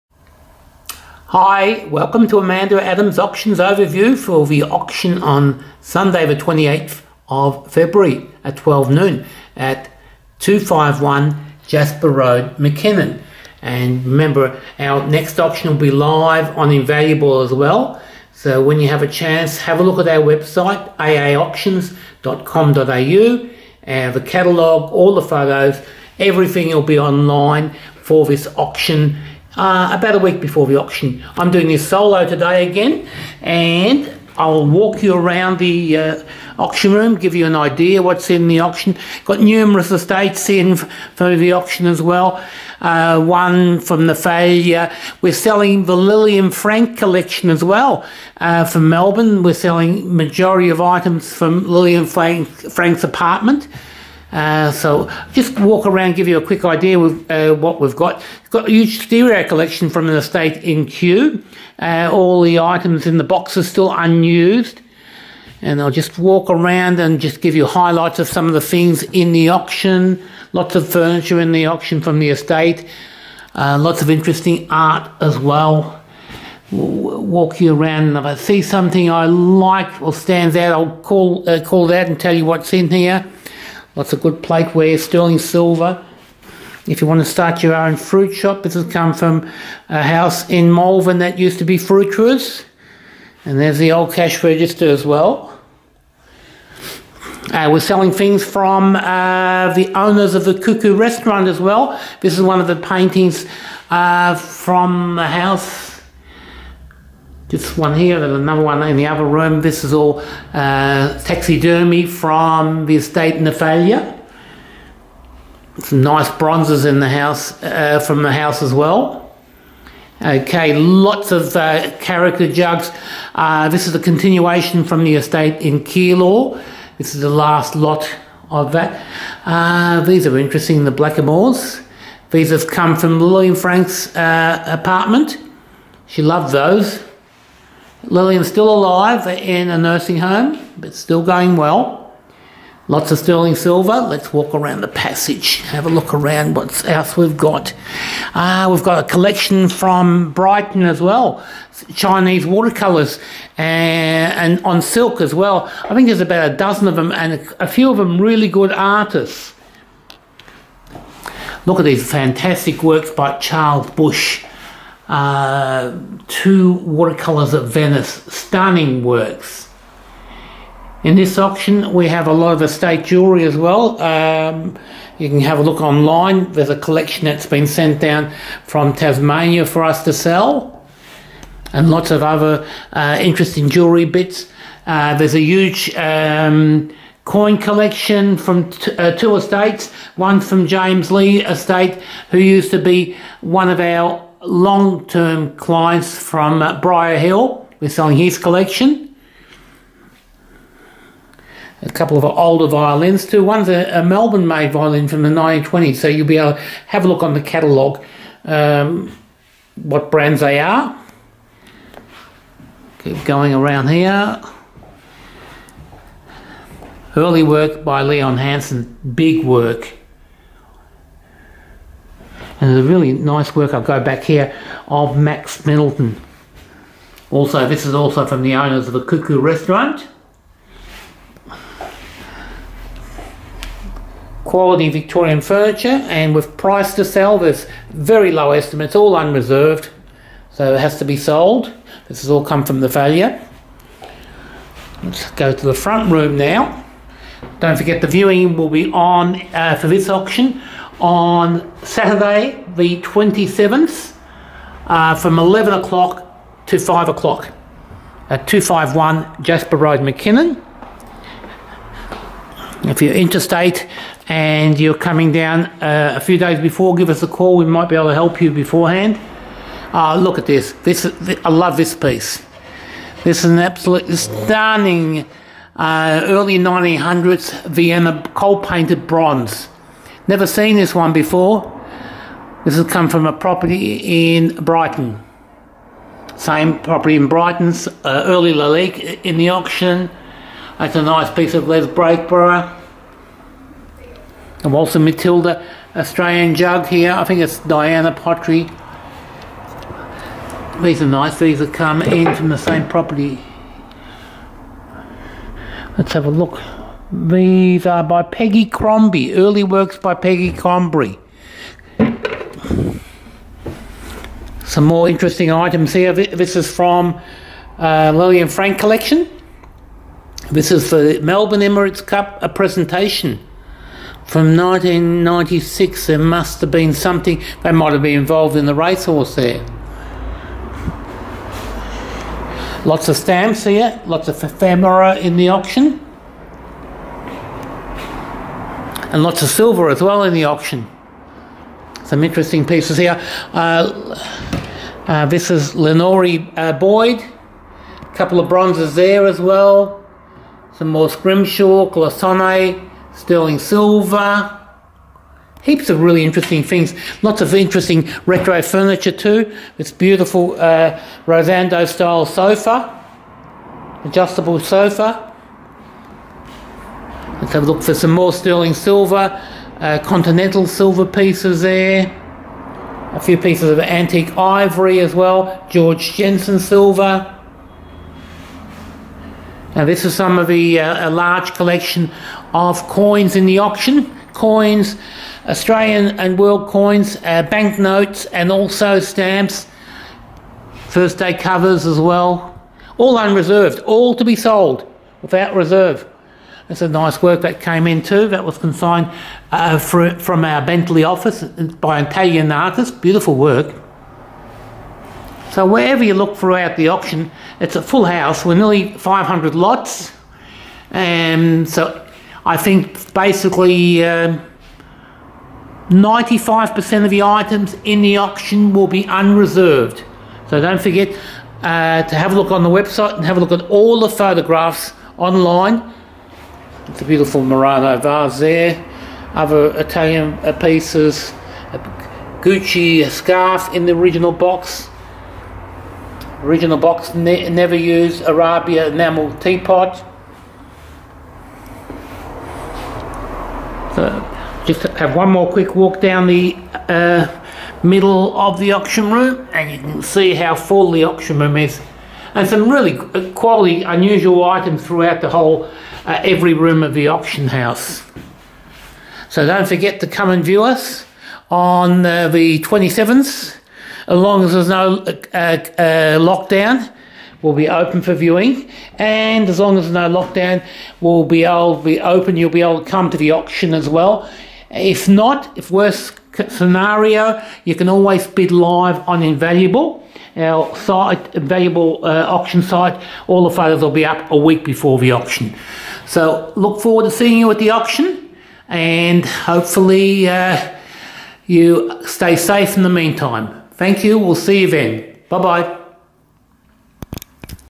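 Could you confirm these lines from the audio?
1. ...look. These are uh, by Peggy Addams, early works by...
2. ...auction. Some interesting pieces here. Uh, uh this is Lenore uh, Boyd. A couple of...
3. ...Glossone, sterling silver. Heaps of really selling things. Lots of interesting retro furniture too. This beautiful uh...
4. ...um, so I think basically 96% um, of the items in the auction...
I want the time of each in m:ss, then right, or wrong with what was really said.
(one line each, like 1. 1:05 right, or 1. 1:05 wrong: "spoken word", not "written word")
1. 5:06 wrong: "Crombie", not "Addams"
2. 5:40 right
3. 5:51 wrong: "interesting", not "selling"
4. 6:51 wrong: "95", not "96".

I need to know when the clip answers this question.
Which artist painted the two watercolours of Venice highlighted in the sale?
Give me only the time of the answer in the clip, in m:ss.
2:43.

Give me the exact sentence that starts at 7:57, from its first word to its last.
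You can always bid live on Invaluable, our site, Invaluable uh, auction site.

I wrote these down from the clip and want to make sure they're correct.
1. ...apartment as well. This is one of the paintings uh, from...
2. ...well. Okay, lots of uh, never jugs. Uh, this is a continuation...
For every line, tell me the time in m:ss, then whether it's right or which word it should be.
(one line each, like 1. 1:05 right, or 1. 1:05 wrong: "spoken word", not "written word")
1. 1:40 wrong: "restaurant", not "apartment"
2. 1:58 wrong: "character", not "never".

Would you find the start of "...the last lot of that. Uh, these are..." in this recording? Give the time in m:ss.
2:07.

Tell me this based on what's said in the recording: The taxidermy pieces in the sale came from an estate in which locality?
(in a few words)
Napthalia.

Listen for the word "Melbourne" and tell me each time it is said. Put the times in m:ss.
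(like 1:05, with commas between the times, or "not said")
0:48, 3:24, 5:21.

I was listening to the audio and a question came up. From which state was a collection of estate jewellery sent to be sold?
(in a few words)
Tasmania.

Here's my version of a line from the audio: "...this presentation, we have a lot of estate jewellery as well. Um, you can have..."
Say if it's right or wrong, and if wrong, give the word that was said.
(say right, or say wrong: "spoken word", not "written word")
wrong: "auction", not "presentation".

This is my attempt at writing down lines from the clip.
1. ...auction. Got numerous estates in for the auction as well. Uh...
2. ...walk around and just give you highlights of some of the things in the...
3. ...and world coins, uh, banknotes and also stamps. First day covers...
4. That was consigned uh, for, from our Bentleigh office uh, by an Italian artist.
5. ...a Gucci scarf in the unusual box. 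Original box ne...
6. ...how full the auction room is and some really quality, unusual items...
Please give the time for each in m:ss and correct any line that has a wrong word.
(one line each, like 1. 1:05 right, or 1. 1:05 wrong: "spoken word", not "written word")
1. 0:38 right
2. 1:06 right
3. 6:26 right
4. 6:38 right
5. 7:11 wrong: "original", not "unusual"
6. 7:30 right.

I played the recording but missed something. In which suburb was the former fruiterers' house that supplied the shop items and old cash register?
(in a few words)
Malvern.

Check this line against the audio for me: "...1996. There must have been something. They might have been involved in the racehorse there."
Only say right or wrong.
right.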